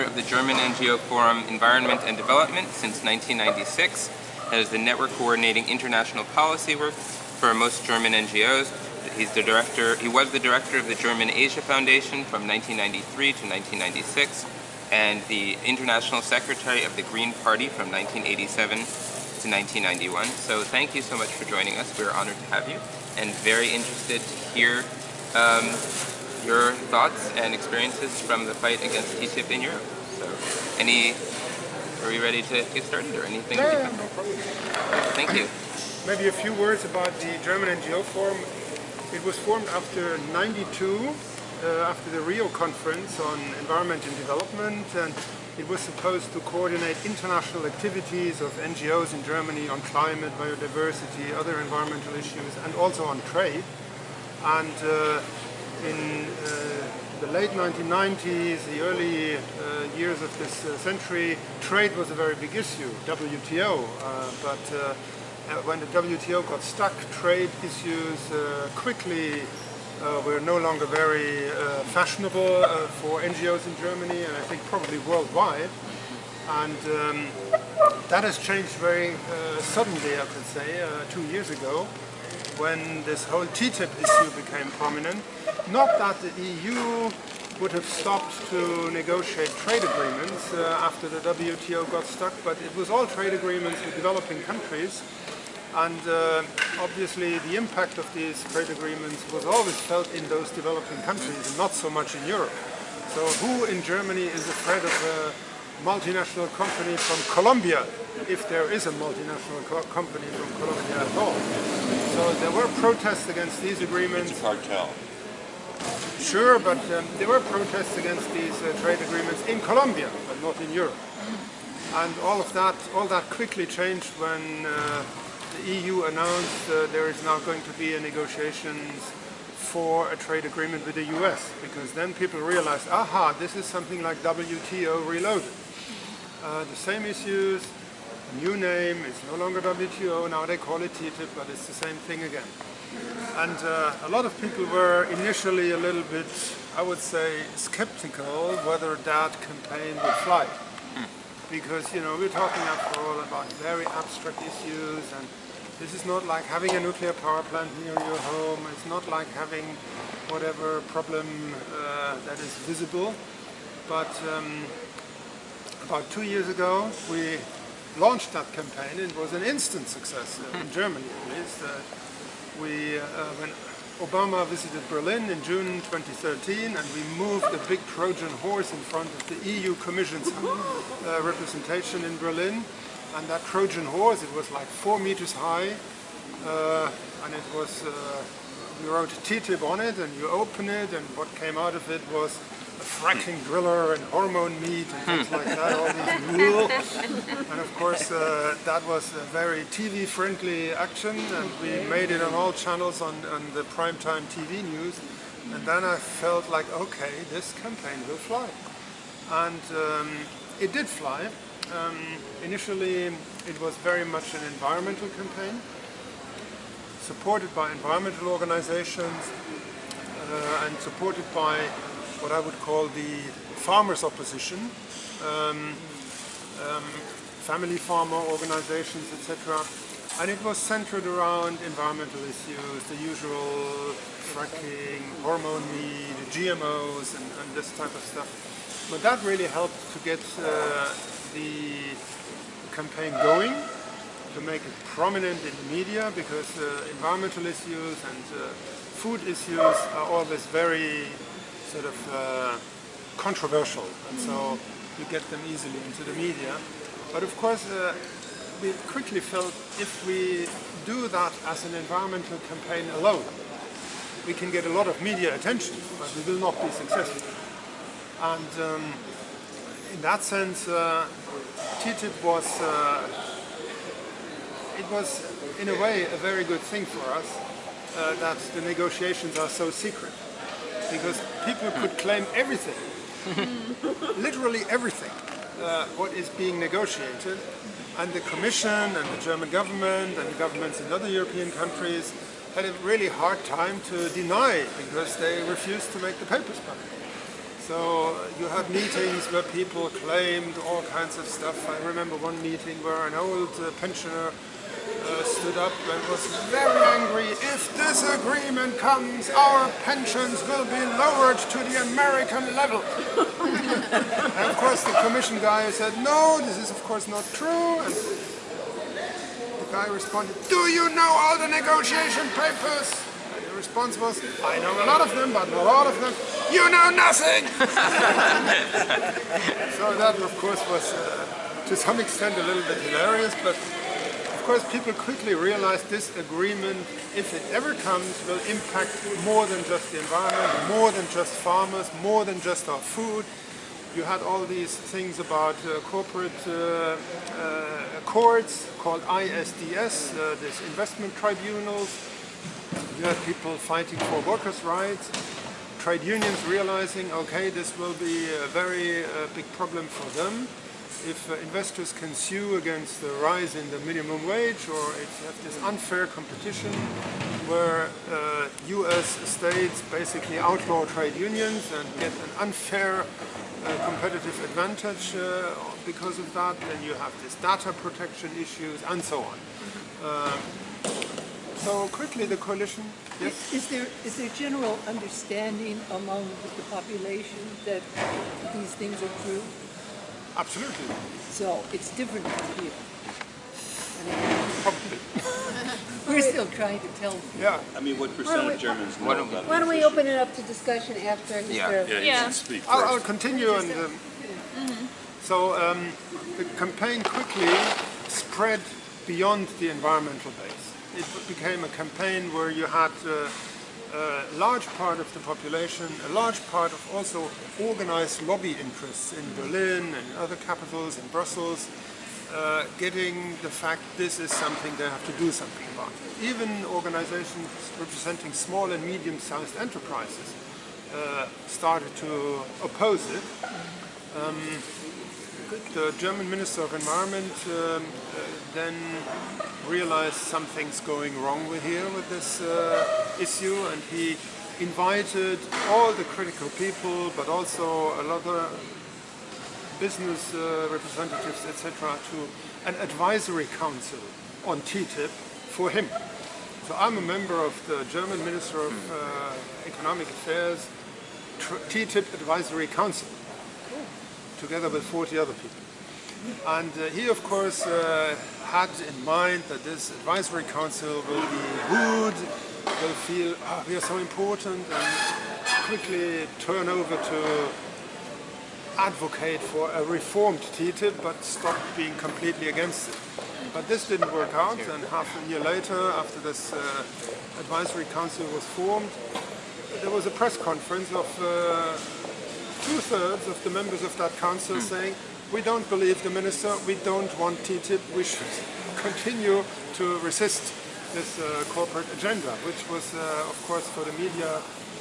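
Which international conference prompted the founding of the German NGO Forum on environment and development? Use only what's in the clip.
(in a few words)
Rio conference.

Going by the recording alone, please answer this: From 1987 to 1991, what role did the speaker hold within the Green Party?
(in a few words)
International secretary.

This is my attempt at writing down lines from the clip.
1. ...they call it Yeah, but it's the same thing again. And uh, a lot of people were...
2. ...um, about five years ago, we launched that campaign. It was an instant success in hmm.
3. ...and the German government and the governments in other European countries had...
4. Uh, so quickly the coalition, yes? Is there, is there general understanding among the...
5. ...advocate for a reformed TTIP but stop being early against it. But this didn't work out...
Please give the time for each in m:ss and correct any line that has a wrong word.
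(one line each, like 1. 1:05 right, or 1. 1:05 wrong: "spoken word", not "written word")
1. 2:20 wrong: "TTIP", not "Yeah"
2. 2:44 wrong: "two", not "five"
3. 4:48 right
4. 6:20 right
5. 7:58 wrong: "completely", not "early".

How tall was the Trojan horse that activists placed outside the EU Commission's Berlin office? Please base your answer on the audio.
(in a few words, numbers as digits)
4 meters.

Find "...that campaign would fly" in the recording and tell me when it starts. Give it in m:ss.
2:29.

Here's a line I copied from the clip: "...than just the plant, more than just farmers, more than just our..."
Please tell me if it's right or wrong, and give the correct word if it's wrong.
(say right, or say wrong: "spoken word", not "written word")
wrong: "environment", not "plant".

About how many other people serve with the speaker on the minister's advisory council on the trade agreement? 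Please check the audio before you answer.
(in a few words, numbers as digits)
40.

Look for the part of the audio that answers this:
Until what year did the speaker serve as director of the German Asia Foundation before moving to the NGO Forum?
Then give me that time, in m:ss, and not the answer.
0:12.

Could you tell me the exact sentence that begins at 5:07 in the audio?
If this agreement comes, our pensions will be lowered to the American level.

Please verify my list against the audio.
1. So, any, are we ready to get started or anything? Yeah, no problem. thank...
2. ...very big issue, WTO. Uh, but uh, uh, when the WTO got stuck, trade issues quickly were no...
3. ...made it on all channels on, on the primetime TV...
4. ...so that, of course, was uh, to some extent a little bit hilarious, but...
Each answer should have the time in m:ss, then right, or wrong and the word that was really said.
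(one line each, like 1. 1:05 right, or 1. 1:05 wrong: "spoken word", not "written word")
1. 0:30 right
2. 1:02 right
3. 3:21 right
4. 5:29 right.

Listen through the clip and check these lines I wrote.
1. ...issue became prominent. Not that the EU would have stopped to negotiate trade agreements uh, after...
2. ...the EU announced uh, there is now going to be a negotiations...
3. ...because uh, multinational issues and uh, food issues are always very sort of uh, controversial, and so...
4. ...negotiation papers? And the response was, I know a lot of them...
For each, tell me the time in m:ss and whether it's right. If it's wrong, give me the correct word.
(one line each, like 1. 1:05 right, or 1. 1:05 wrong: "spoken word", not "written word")
1. 1:24 right
2. 2:05 right
3. 4:06 wrong: "environmental", not "multinational"
4. 5:21 right.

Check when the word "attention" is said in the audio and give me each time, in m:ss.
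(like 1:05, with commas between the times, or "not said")
4:25.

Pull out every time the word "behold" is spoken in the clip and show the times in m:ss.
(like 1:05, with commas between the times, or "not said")
not said.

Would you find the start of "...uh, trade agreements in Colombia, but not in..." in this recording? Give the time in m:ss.
1:58.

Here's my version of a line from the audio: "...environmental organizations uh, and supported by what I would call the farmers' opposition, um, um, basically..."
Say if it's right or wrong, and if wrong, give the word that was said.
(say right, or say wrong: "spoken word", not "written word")
wrong: "family", not "basically".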